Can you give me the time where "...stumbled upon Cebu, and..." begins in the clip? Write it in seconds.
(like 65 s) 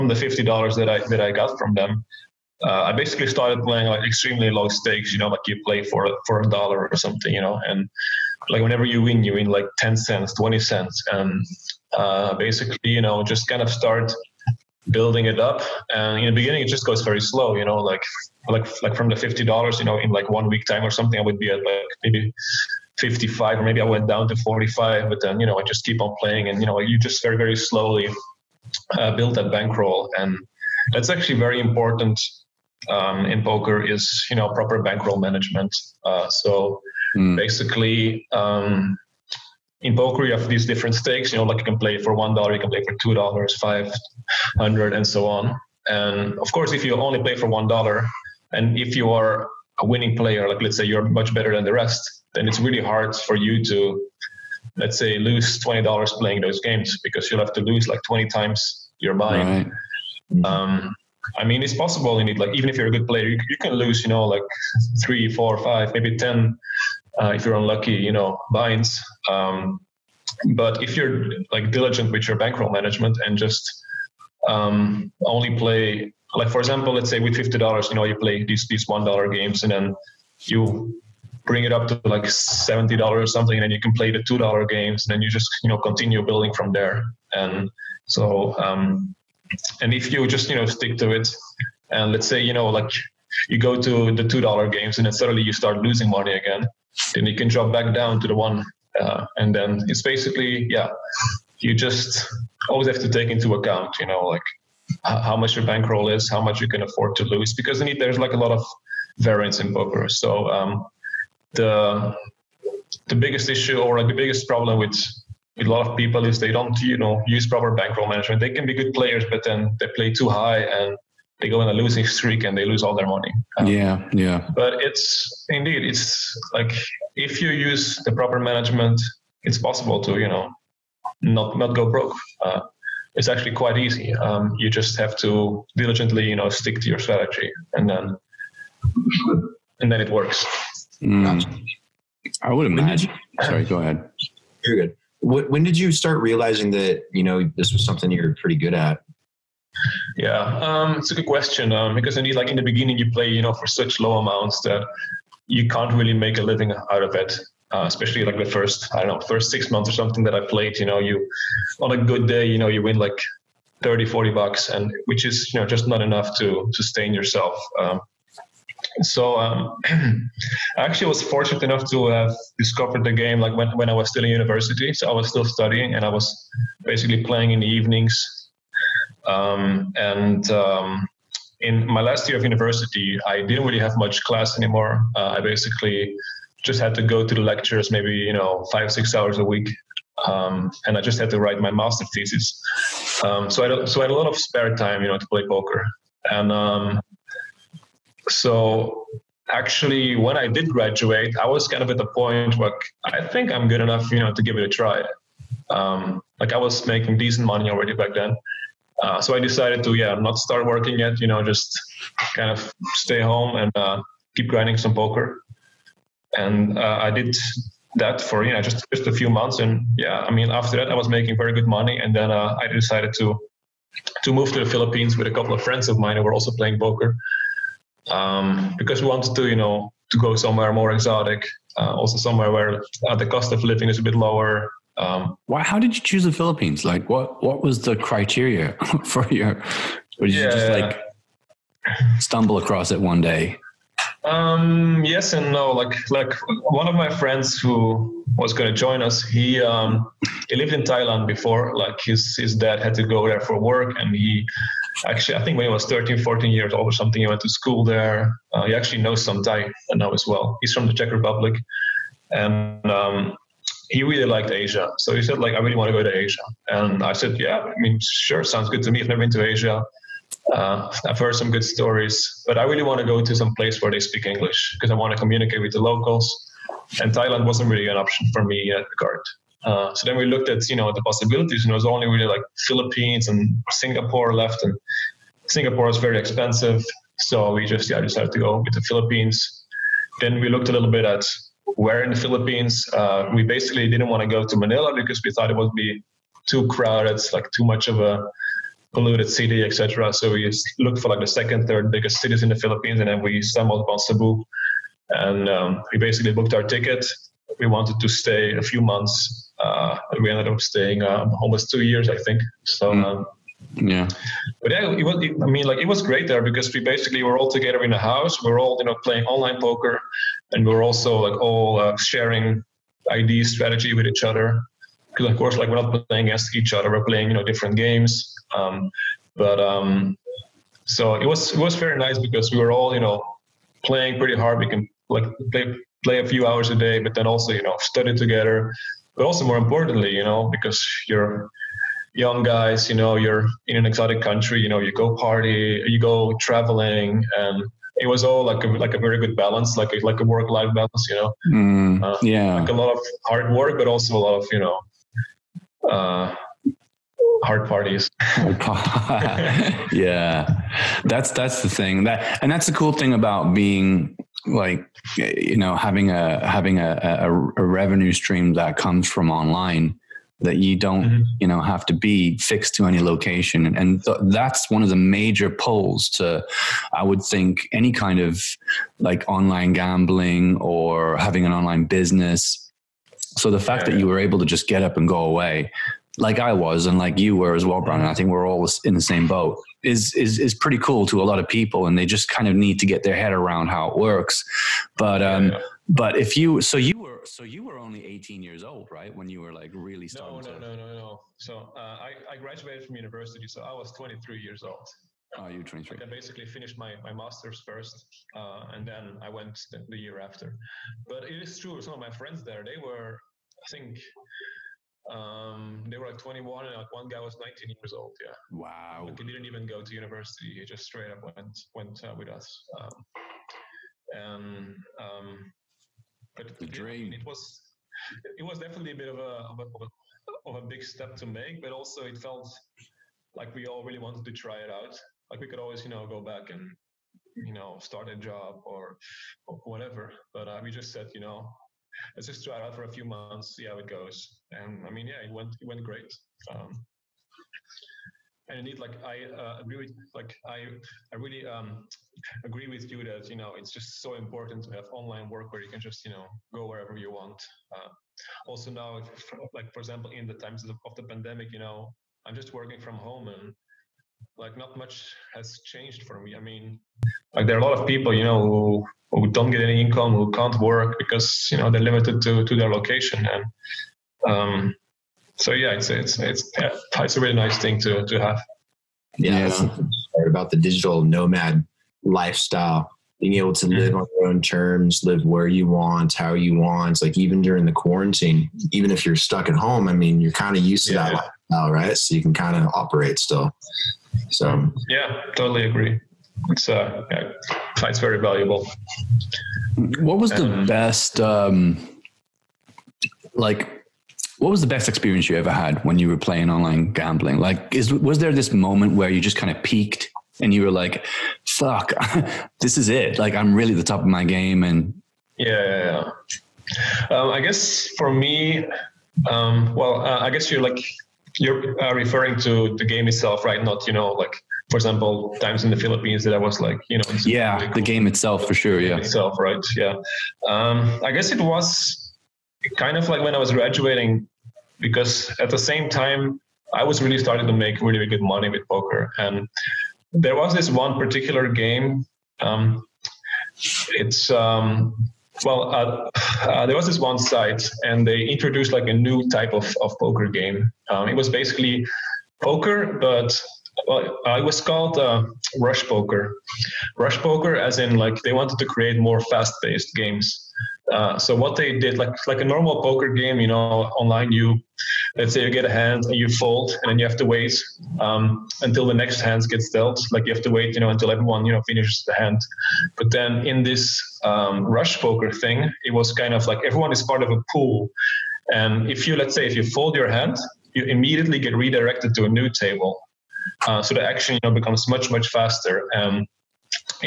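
303 s.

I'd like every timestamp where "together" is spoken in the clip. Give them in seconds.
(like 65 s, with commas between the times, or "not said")
317 s, 338 s.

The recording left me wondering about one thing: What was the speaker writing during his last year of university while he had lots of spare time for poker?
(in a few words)
Master thesis.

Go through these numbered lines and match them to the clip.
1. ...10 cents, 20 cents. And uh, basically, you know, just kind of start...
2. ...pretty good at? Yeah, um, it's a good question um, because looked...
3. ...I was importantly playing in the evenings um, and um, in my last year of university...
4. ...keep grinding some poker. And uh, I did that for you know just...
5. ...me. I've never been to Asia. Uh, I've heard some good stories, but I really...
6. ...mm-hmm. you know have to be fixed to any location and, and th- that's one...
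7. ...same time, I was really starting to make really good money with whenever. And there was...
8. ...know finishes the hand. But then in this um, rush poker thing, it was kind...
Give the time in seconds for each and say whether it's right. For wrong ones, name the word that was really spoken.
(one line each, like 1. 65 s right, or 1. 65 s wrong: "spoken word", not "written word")
1. 9 s right
2. 148 s wrong: "indeed", not "looked"
3. 176 s wrong: "basically", not "importantly"
4. 214 s right
5. 268 s right
6. 371 s right
7. 535 s wrong: "poker", not "whenever"
8. 571 s right.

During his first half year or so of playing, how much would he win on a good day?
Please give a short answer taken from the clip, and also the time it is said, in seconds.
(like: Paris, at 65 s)
30 to 40 bucks, at 163 s.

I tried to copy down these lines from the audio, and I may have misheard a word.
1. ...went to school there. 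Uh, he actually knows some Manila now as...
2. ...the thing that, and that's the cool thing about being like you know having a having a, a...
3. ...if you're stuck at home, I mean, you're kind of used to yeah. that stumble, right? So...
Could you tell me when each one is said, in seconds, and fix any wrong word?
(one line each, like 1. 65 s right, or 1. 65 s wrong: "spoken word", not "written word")
1. 257 s wrong: "Thai", not "Manila"
2. 361 s right
3. 488 s wrong: "lifestyle", not "stumble".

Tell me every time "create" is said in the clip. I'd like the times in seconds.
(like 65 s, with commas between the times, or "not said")
558 s.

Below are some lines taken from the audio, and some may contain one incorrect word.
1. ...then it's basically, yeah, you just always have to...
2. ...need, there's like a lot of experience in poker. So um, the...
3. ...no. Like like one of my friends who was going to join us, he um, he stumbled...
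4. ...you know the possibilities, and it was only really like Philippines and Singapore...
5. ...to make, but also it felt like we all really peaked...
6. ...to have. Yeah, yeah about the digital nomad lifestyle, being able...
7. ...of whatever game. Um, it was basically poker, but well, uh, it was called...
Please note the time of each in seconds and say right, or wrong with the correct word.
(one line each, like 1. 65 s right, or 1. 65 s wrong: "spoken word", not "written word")
1. 99 s right
2. 107 s wrong: "variance", not "experience"
3. 245 s wrong: "lived", not "stumbled"
4. 280 s right
5. 431 s wrong: "wanted", not "peaked"
6. 478 s right
7. 549 s wrong: "poker", not "whatever".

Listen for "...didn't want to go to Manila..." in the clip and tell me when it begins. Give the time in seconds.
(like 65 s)
293 s.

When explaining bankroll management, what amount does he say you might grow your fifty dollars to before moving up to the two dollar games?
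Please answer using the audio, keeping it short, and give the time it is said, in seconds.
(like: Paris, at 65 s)
$70, at 82 s.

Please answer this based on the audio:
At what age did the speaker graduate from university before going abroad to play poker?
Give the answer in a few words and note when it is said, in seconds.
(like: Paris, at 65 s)
23, at 403 s.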